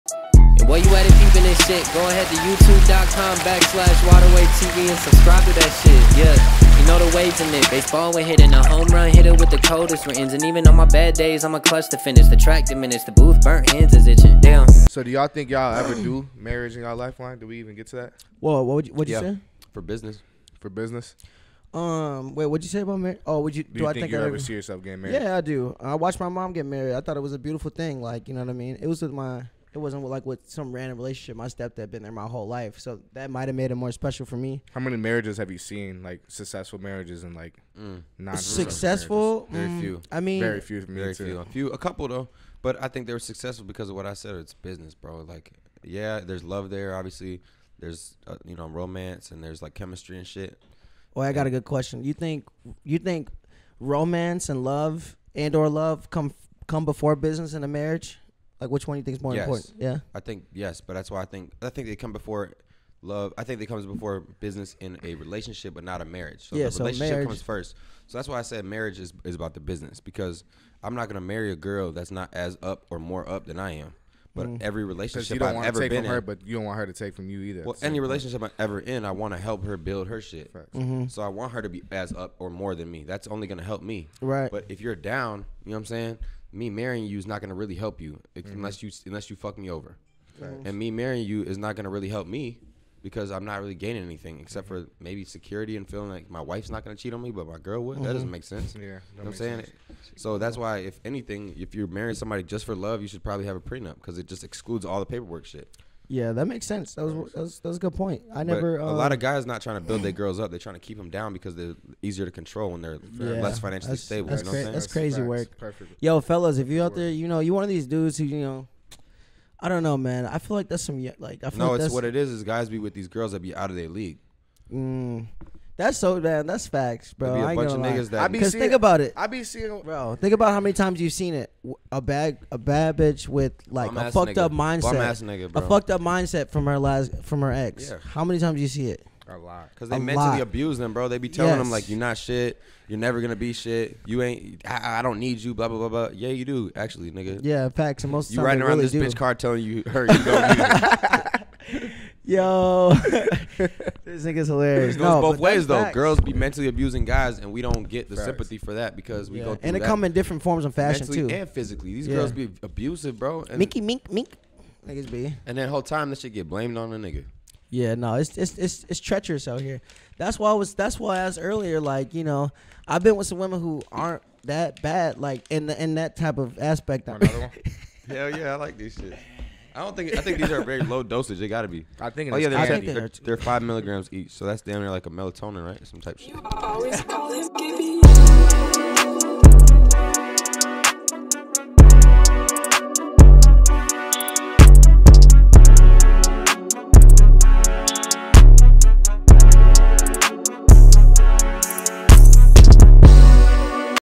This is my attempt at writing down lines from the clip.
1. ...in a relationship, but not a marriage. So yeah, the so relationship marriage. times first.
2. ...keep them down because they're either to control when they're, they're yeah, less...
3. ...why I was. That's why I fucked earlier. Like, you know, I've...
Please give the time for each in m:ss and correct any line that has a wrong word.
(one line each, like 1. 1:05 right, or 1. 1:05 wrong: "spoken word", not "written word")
1. 1:04 wrong: "comes", not "times"
2. 1:50 wrong: "easier", not "either"
3. 2:50 wrong: "asked", not "fucked".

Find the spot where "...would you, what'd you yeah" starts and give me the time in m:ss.
0:18.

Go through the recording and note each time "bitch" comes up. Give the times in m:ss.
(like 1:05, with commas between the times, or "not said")
2:12, 2:29.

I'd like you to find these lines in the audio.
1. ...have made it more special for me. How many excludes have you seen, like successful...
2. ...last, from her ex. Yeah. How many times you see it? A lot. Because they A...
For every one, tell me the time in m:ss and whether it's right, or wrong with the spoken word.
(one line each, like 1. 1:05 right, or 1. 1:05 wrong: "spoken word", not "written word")
1. 0:33 wrong: "marriages", not "excludes"
2. 2:16 right.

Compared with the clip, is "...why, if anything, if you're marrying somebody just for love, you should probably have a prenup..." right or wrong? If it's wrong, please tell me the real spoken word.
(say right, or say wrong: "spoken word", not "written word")
right.